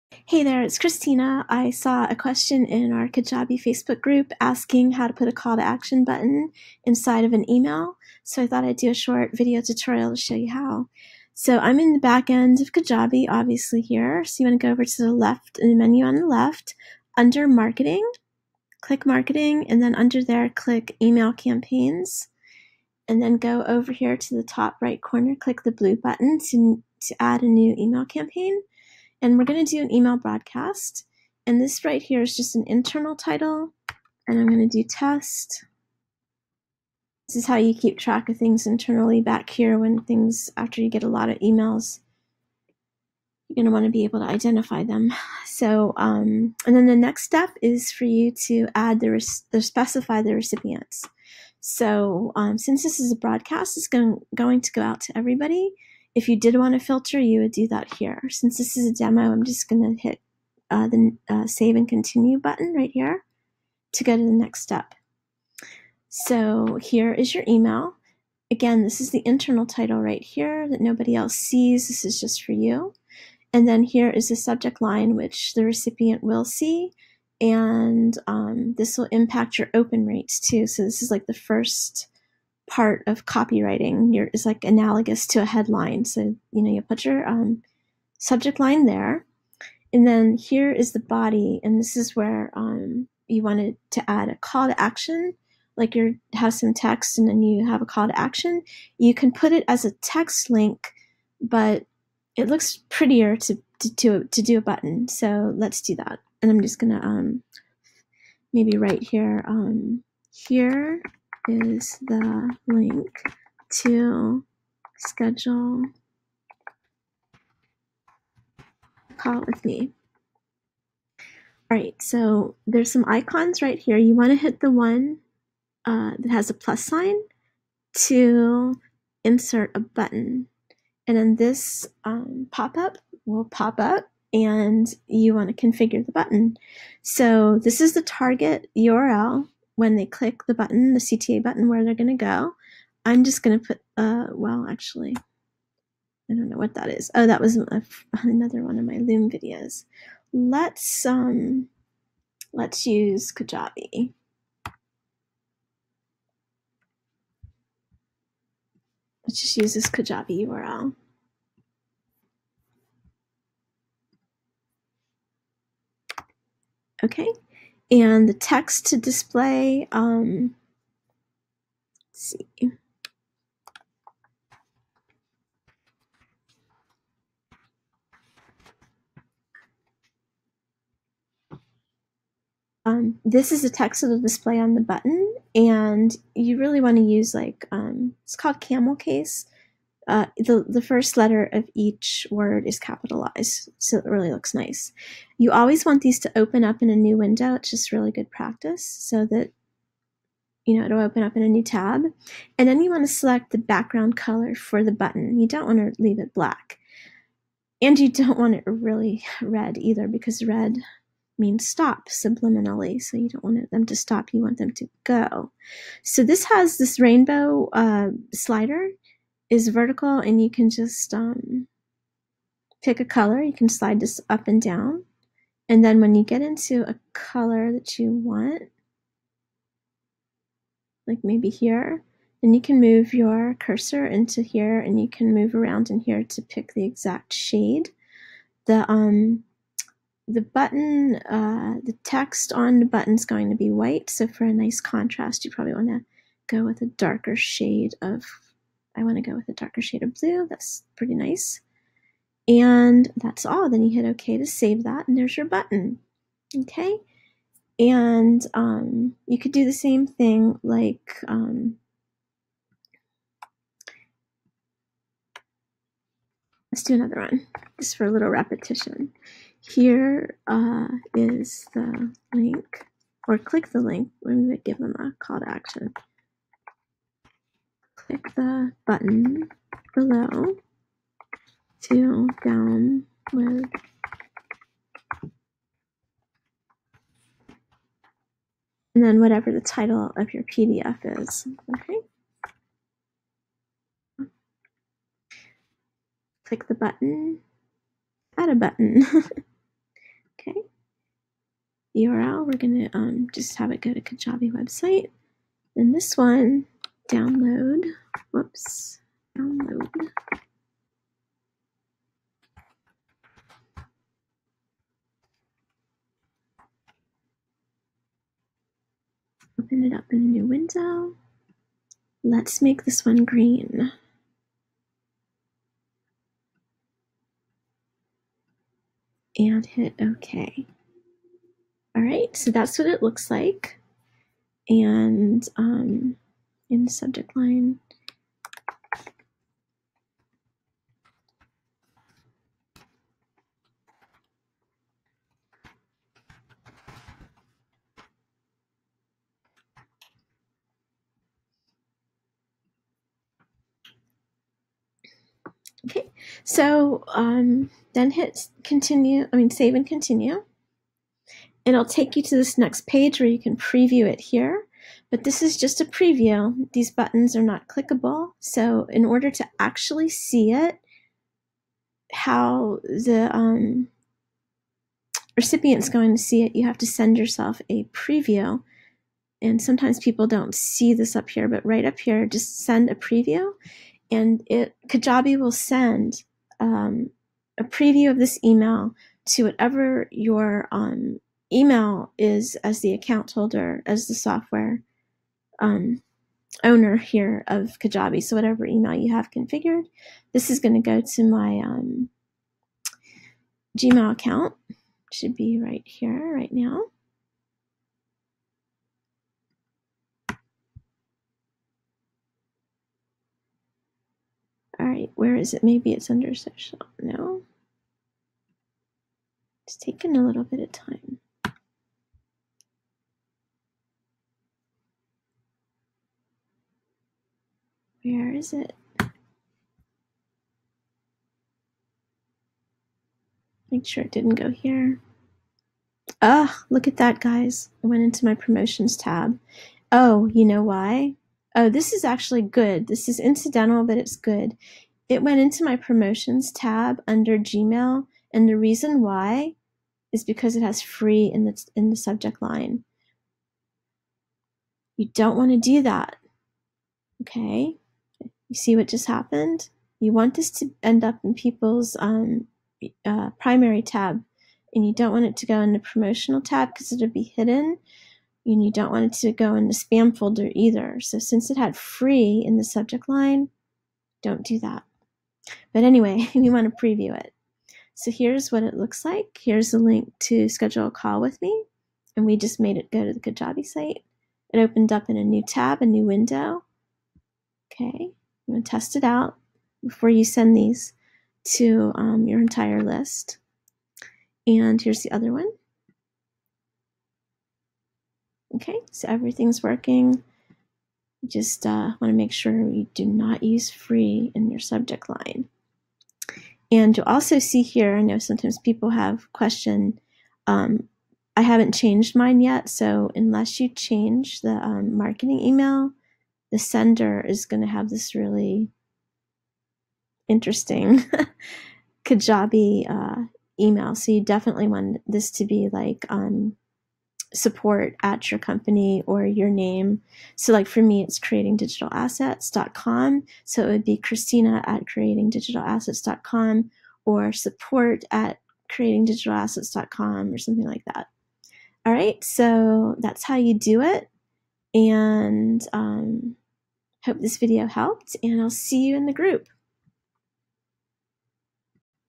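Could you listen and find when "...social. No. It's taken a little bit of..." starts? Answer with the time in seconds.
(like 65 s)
416 s.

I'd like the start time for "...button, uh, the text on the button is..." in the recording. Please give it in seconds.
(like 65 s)
240 s.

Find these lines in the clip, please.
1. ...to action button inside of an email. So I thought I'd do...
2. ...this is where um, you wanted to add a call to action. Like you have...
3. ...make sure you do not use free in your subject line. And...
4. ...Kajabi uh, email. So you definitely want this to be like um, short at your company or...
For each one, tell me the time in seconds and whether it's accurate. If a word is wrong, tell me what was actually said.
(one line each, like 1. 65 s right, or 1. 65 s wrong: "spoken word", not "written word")
1. 5 s right
2. 91 s right
3. 502 s right
4. 522 s wrong: "support", not "short".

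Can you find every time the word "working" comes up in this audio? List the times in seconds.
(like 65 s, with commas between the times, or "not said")
499 s.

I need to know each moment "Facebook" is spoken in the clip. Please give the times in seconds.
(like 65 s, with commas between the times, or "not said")
3 s.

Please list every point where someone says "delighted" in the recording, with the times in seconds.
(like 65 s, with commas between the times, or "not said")
not said.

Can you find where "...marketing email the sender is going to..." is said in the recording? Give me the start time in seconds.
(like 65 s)
514 s.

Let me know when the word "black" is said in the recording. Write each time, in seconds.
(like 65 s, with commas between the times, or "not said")
206 s.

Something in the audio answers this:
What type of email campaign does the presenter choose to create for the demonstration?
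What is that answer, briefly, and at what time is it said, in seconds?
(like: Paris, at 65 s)
Email broadcast, at 29 s.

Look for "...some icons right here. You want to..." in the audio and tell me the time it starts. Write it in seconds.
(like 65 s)
122 s.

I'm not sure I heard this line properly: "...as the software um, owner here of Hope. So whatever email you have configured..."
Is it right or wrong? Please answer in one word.
wrong.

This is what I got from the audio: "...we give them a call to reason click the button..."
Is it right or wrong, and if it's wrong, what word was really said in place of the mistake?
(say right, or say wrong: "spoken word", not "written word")
wrong: "action", not "reason".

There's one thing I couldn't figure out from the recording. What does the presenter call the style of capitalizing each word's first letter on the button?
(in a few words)
Camel Case.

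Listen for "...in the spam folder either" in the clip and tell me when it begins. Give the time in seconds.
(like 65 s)
469 s.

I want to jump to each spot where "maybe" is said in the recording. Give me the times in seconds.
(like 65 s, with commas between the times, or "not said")
108 s, 231 s, 415 s.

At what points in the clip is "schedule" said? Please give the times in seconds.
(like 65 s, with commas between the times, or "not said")
114 s, 480 s.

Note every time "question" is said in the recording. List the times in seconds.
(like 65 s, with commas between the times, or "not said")
2 s, 509 s.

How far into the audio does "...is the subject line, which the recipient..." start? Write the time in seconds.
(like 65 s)
74 s.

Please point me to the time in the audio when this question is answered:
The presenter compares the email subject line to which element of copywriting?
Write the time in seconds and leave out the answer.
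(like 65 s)
85 s.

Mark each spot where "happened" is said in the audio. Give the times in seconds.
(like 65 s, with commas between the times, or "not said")
459 s.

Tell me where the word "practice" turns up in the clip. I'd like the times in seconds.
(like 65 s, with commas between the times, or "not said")
198 s.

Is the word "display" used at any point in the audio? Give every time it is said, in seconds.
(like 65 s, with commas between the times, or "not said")
168 s, 184 s.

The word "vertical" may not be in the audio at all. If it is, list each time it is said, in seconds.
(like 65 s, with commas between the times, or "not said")
219 s.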